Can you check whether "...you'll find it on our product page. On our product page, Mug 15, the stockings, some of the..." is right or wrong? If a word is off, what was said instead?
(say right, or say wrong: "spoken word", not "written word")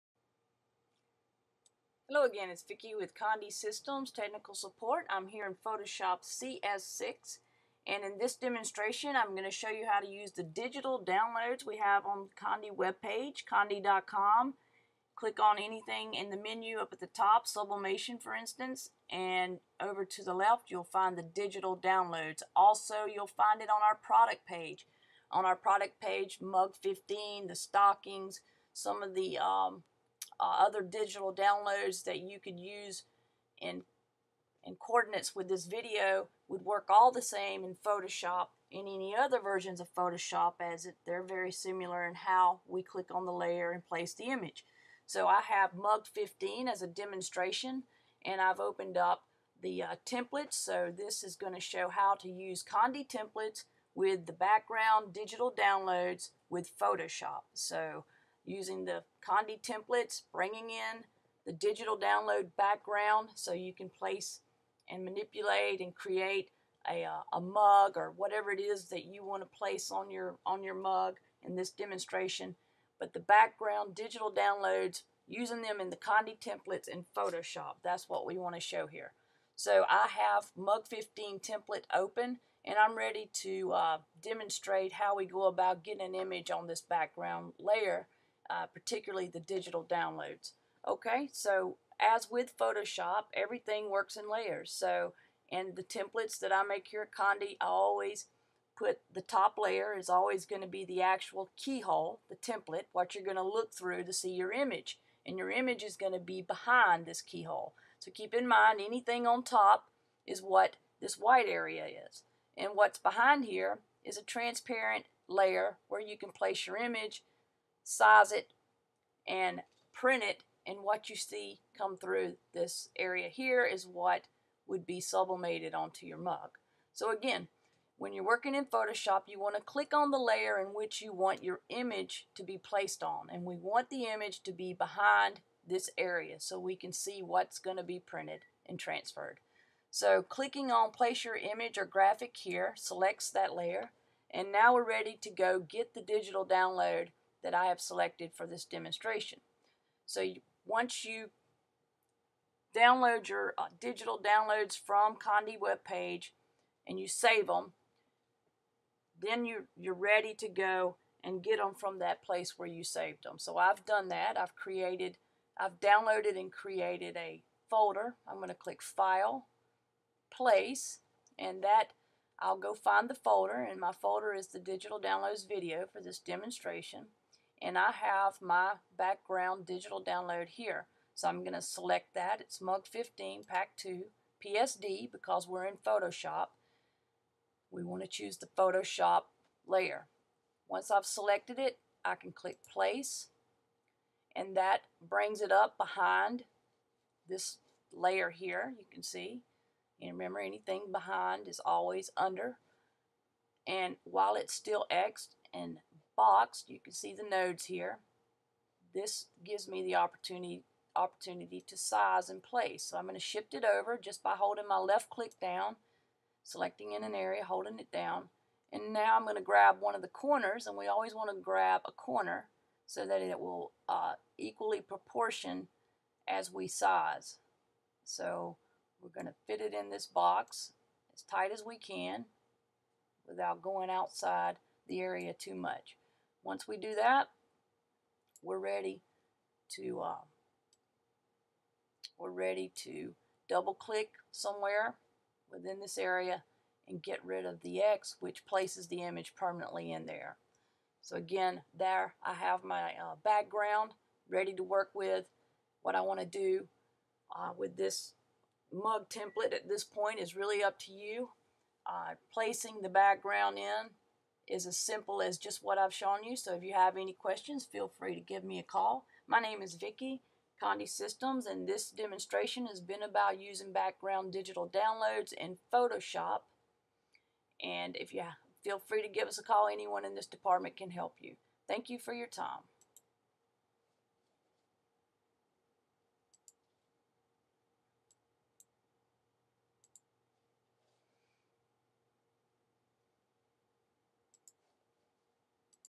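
right.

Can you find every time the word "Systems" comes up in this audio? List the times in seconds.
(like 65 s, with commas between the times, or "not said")
3 s, 270 s.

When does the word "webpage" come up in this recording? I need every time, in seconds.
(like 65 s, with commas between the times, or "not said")
12 s, 155 s.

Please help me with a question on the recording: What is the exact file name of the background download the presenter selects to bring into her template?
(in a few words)
MUG 15 Pack 2 PSD.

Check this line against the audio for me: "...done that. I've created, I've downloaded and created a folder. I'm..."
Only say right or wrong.
right.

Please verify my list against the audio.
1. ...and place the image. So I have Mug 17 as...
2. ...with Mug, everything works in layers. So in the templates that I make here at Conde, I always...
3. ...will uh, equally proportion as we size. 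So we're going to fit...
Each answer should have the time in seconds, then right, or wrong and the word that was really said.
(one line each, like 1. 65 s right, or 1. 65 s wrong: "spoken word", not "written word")
1. 43 s wrong: "15", not "17"
2. 92 s wrong: "Photoshop", not "Mug"
3. 223 s right.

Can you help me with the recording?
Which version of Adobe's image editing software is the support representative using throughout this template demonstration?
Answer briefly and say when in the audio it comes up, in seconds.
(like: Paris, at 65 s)
Photoshop CS6, at 5 s.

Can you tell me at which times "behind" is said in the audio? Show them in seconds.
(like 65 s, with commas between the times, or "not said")
106 s, 112 s, 134 s, 195 s, 200 s.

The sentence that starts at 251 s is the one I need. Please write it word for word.
So again there I have my uh, background ready to work with.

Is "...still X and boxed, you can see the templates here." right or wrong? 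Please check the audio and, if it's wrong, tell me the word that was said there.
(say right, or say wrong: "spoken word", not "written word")
wrong: "nodes", not "templates".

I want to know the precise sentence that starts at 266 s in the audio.
So if you have any questions, feel free to give me a call.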